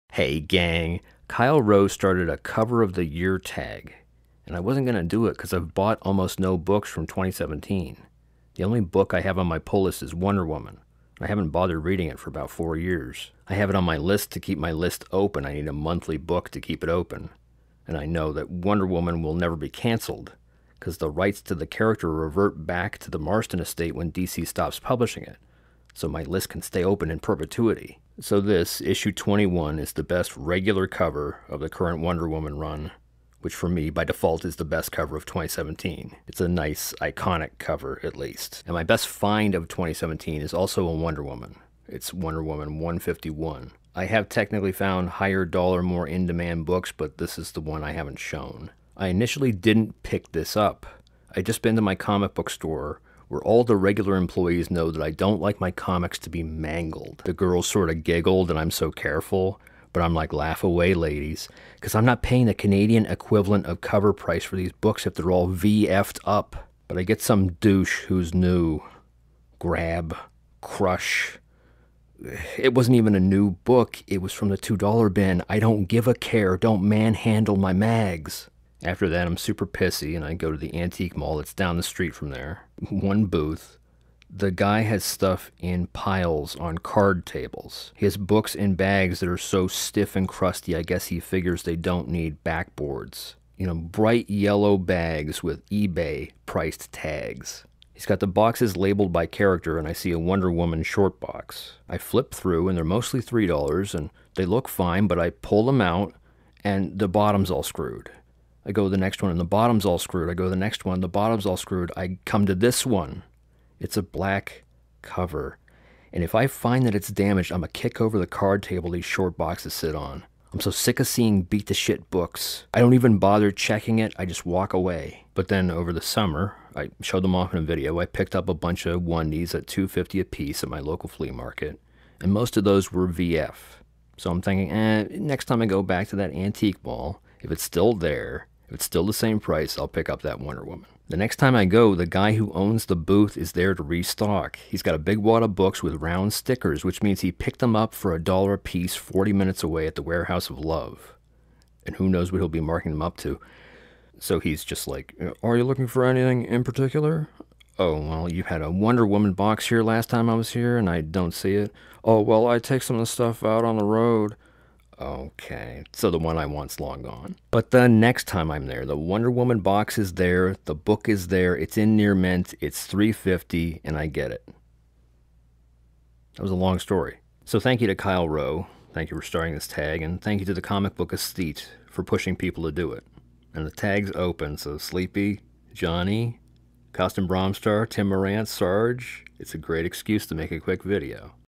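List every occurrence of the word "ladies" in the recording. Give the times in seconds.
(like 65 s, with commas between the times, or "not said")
60 s.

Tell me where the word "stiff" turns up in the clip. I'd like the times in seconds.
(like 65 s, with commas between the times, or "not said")
89 s.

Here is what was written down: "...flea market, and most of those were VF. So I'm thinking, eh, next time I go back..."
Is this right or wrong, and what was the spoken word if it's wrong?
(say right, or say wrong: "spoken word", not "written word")
right.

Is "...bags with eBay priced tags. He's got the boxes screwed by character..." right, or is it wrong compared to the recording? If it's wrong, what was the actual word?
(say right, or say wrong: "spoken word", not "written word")
wrong: "labeled", not "screwed".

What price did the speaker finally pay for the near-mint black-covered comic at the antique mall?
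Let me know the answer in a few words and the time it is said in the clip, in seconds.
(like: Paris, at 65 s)
350, at 172 s.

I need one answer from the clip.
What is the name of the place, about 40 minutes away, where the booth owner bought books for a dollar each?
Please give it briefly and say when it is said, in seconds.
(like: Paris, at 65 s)
Warehouse of Love, at 150 s.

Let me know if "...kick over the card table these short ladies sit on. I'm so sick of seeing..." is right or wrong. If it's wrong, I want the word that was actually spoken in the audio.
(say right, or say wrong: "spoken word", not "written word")
wrong: "boxes", not "ladies".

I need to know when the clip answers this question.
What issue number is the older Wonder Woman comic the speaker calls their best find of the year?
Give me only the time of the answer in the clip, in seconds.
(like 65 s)
42 s.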